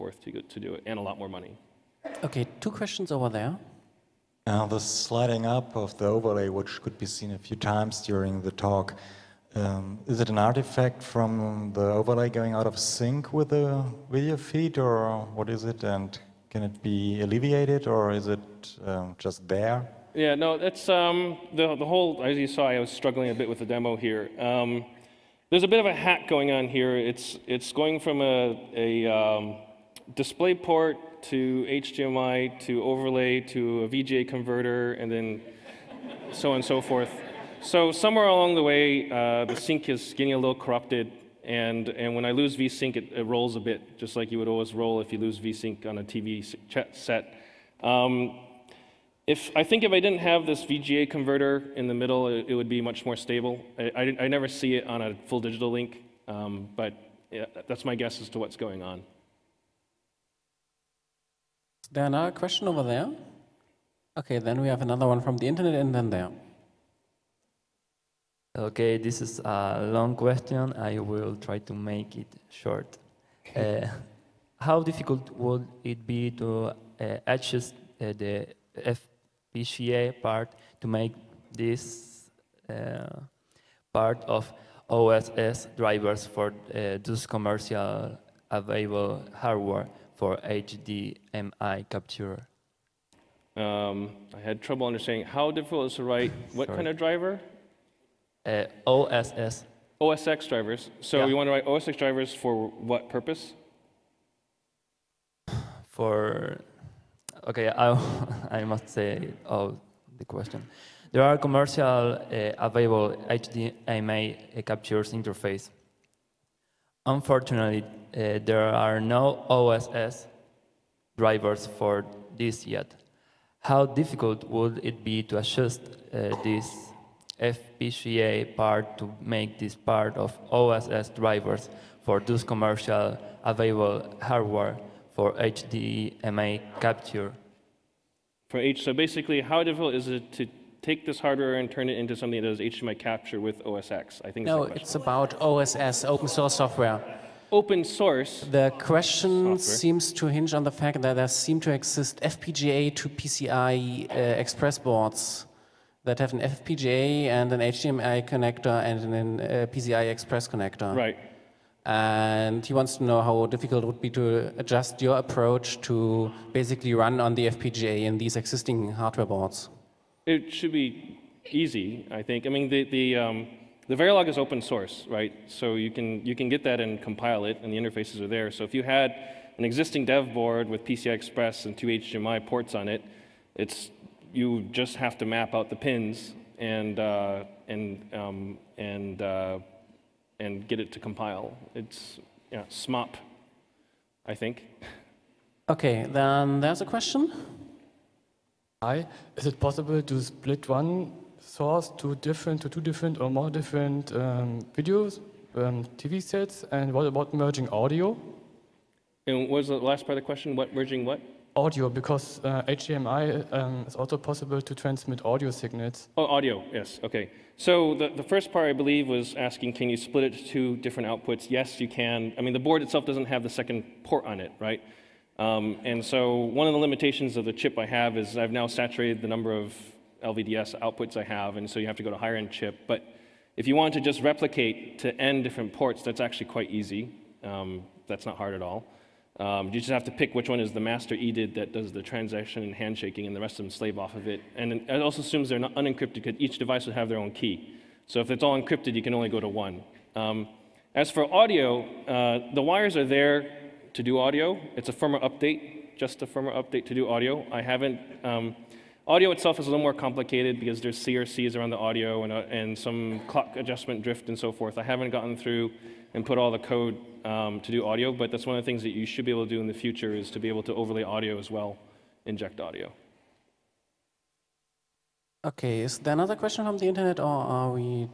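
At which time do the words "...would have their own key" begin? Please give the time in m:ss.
4:06.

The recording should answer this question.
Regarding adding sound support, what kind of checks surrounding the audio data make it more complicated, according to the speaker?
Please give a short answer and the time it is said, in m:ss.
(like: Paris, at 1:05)
CRCs, at 4:21.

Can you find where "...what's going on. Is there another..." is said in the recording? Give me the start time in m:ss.
0:58.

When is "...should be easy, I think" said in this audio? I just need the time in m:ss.
2:50.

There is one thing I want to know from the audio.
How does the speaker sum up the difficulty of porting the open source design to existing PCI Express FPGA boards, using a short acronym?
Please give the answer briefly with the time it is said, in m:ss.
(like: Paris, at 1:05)
SMOP, at 3:12.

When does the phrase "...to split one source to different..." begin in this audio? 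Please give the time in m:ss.
3:20.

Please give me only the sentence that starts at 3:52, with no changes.
But if you want to just replicate to n different ports, that's actually quite easy.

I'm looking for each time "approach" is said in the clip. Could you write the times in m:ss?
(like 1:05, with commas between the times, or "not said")
2:45.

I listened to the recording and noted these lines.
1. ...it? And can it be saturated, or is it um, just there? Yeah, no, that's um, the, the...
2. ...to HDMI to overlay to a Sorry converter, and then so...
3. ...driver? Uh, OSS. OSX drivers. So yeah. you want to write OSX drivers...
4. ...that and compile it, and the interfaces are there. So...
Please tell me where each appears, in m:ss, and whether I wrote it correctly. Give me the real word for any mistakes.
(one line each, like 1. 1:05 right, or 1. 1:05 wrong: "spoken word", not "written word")
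1. 0:15 wrong: "alleviated", not "saturated"
2. 0:31 wrong: "VGA", not "Sorry"
3. 1:36 right
4. 2:56 right.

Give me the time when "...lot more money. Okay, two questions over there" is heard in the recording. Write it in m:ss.
0:01.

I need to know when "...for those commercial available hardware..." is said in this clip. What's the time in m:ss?
2:12.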